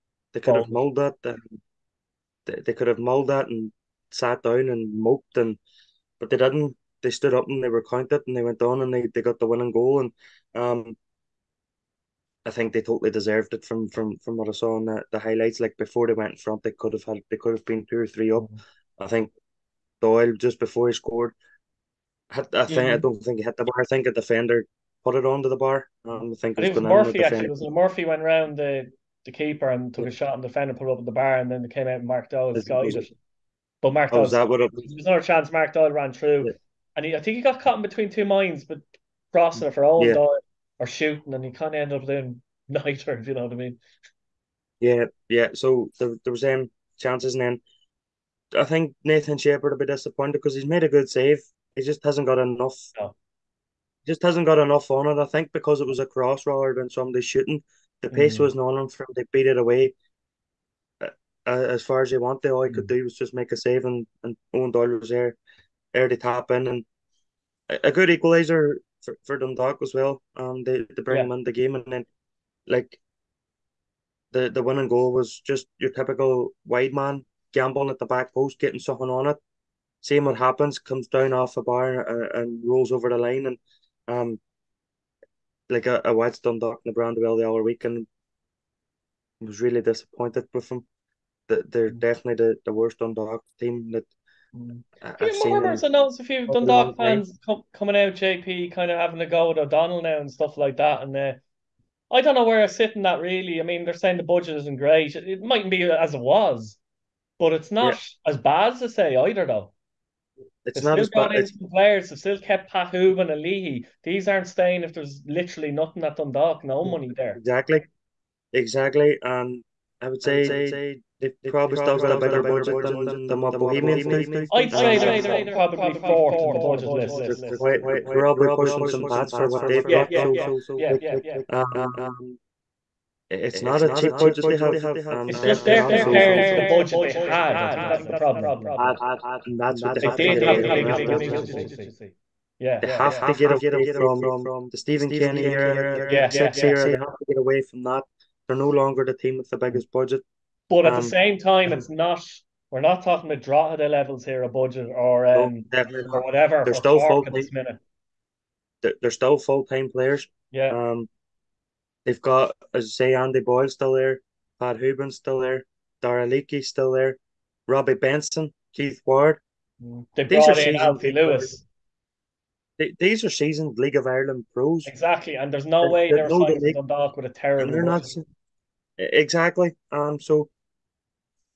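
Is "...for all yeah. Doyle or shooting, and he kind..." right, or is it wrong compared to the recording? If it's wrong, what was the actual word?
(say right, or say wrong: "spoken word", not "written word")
right.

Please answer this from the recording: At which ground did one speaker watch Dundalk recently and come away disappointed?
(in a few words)
Brandywell.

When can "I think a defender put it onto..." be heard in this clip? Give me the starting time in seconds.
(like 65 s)
23 s.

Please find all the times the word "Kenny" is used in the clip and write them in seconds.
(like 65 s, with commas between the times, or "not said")
145 s.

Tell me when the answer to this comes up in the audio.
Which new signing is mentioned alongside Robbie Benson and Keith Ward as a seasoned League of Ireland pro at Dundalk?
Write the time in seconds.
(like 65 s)
170 s.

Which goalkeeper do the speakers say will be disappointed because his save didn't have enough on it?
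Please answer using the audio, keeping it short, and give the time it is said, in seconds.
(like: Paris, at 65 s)
Nathan Shepperd, at 49 s.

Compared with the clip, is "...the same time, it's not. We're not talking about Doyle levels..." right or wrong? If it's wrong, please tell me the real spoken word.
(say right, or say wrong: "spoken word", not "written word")
wrong: "Drogheda", not "Doyle".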